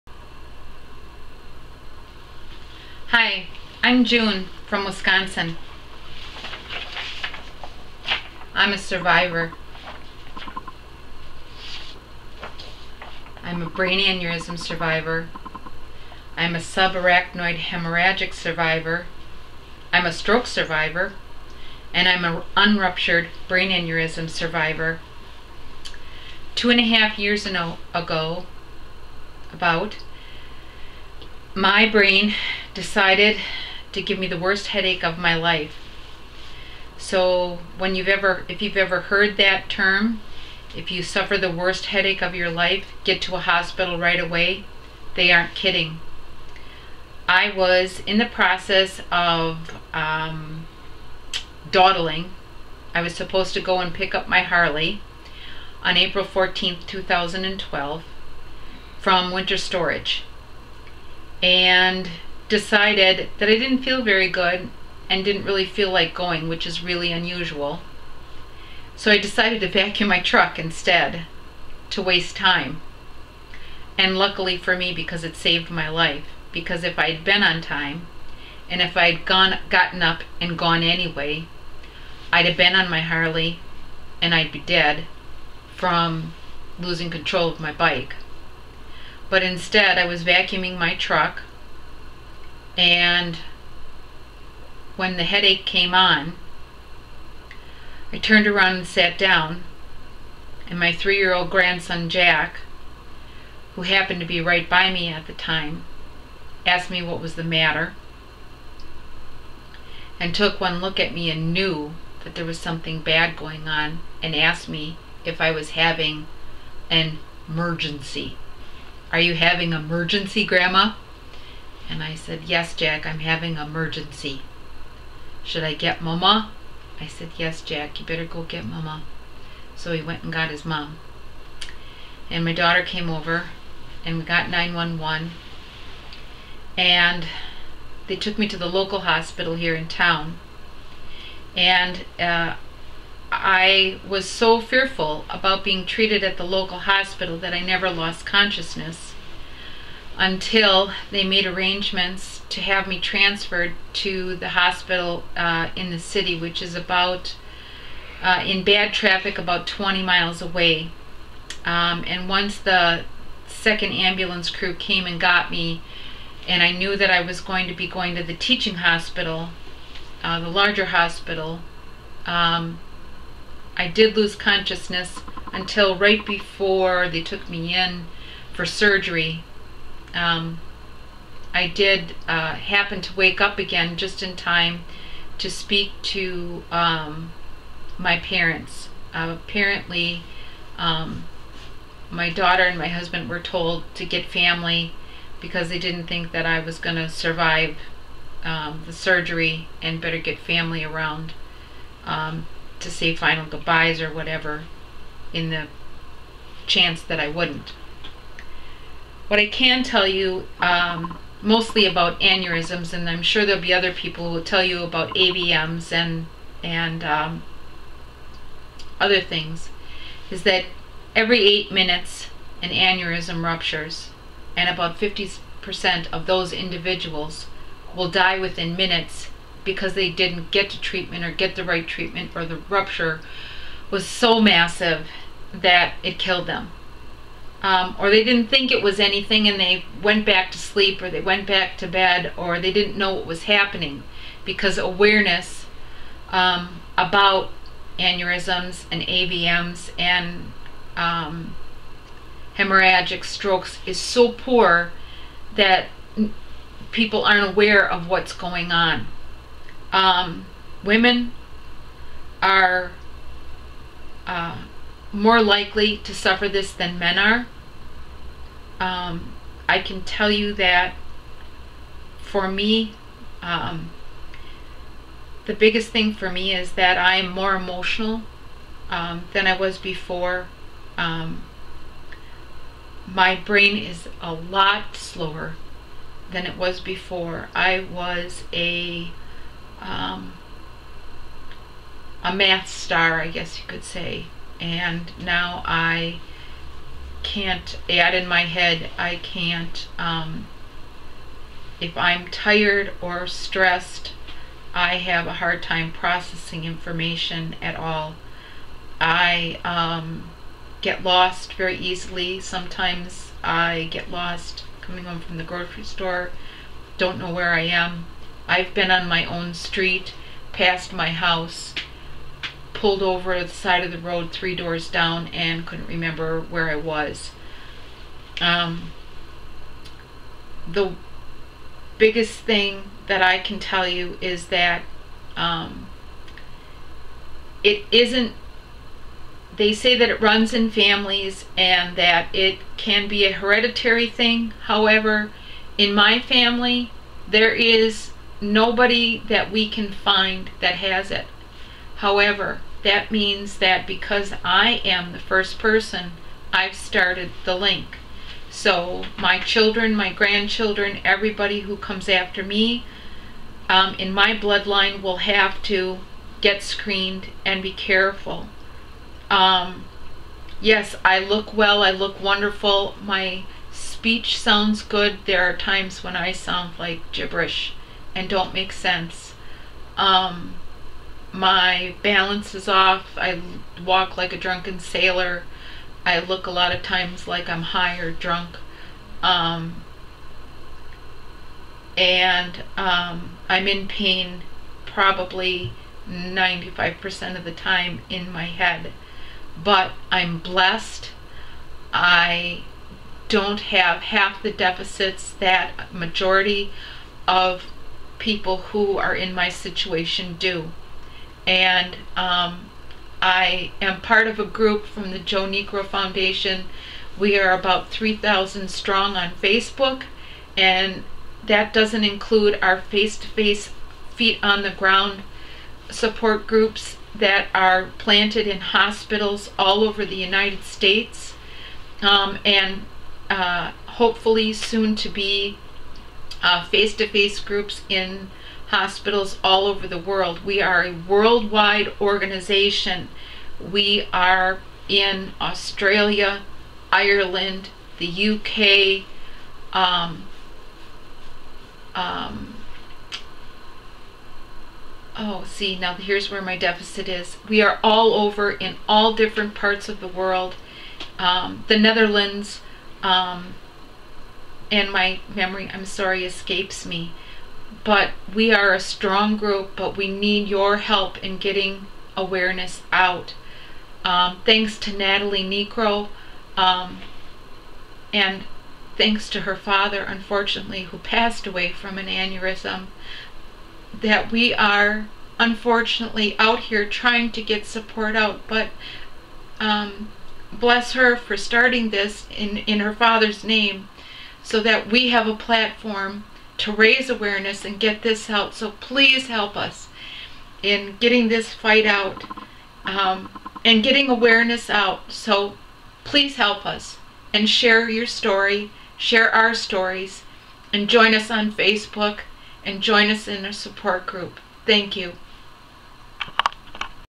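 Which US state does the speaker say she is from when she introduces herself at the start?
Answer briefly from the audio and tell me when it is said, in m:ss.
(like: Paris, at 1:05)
Wisconsin, at 0:04.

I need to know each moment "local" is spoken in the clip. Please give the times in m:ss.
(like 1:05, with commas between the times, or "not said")
2:18, 2:26.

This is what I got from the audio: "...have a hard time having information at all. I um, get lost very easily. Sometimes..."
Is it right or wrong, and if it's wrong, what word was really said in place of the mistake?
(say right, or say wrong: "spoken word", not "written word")
wrong: "processing", not "having".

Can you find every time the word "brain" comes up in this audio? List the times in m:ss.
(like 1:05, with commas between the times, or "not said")
0:13, 0:23, 0:31, 4:43.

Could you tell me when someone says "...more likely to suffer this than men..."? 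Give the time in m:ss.
4:25.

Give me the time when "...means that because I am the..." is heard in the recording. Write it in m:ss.
5:53.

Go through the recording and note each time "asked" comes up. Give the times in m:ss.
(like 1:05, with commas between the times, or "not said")
1:46, 1:54.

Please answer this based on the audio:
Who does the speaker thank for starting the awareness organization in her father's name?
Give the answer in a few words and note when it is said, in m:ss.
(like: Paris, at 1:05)
Natalie Niekro, at 7:54.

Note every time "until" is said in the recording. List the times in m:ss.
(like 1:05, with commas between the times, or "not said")
2:30, 2:55.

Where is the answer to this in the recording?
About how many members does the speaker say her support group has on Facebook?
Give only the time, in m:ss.
6:57.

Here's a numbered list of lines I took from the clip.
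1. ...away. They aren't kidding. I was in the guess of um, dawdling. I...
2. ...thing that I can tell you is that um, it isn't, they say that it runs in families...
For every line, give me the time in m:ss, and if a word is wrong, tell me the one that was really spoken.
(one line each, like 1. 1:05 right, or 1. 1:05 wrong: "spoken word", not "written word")
1. 0:44 wrong: "process", not "guess"
2. 5:32 right.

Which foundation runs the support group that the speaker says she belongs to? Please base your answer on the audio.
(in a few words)
Joe Niekro Foundation.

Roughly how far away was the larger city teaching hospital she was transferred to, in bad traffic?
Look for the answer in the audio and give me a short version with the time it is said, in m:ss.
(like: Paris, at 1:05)
20 miles, at 2:39.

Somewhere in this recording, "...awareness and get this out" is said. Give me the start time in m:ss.
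8:17.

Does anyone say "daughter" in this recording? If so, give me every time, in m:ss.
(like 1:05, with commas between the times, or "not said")
2:12, 3:12.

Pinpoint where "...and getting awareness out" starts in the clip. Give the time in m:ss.
8:23.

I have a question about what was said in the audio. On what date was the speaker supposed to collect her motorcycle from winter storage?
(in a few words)
April 14, 2012.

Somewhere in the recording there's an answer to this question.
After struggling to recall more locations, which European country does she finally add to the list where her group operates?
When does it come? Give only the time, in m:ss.
7:41.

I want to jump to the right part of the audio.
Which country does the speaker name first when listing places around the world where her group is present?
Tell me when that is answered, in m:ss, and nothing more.
7:25.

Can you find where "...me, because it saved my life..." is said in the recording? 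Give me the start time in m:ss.
1:14.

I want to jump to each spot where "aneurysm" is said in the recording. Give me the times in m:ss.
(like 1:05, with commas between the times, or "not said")
0:13, 0:23, 3:32, 3:42, 4:07, 8:02.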